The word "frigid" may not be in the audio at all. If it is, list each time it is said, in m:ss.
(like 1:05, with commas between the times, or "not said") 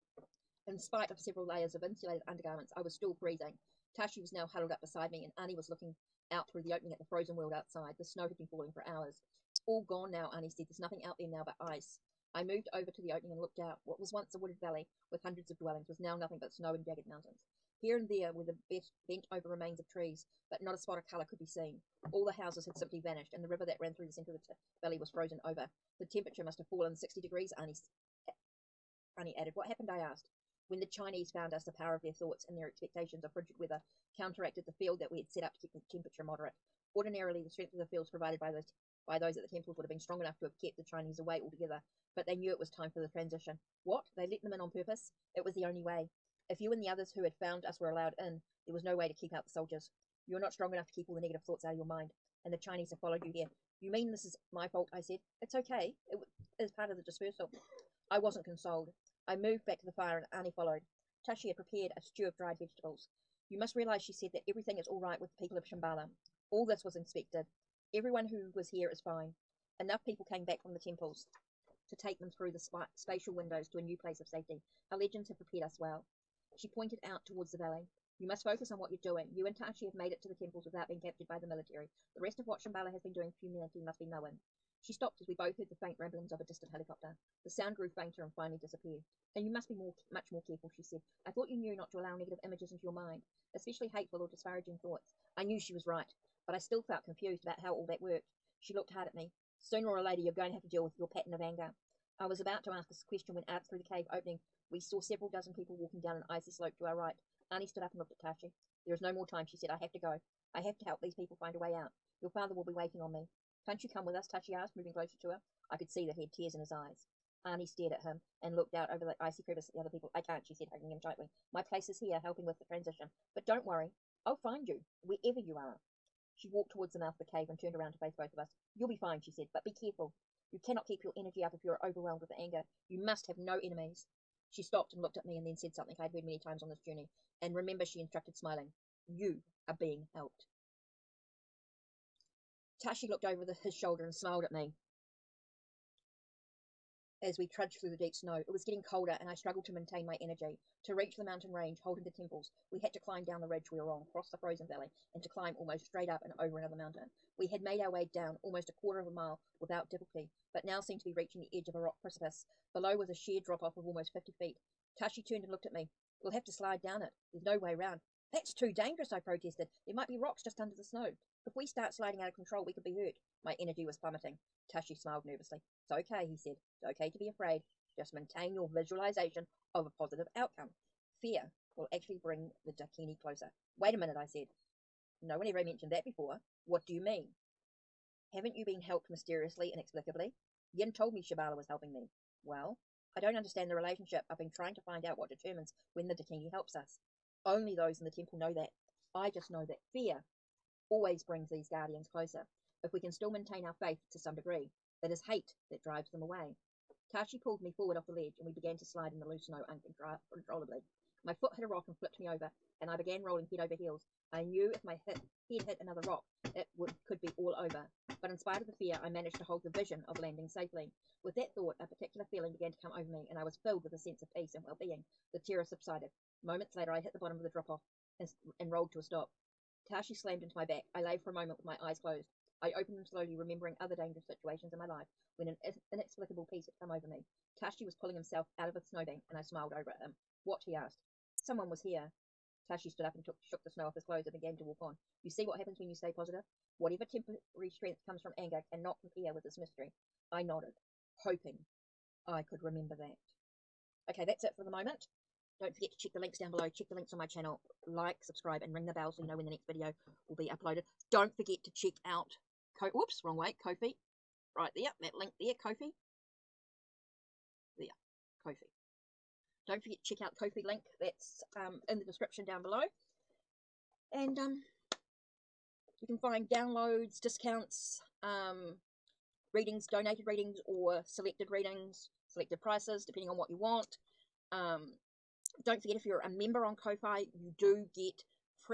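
0:33.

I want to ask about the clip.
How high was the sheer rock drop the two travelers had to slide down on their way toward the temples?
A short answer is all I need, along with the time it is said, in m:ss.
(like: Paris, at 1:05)
50 feet, at 2:44.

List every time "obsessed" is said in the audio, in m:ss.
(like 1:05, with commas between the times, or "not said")
not said.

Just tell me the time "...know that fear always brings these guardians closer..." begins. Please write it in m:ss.
3:19.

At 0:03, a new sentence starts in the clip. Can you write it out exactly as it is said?
Tashi was now huddled up beside me, and Annie was looking out through the opening at the frozen world outside.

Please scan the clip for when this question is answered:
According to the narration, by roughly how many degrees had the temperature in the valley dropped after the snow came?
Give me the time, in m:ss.
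0:26.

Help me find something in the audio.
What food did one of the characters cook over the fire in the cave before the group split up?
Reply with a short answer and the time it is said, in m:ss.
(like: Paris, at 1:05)
Stew of dried vegetables, at 1:02.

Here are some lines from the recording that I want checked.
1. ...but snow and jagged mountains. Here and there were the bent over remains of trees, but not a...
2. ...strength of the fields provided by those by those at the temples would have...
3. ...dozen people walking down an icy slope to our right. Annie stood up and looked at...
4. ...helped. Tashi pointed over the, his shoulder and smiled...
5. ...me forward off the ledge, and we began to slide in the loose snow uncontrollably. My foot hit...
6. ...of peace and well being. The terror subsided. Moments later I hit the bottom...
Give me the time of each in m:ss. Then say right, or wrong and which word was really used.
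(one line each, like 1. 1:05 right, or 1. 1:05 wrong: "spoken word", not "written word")
1. 0:16 right
2. 0:37 right
3. 1:45 right
4. 2:20 wrong: "looked", not "pointed"
5. 3:27 right
6. 3:44 right.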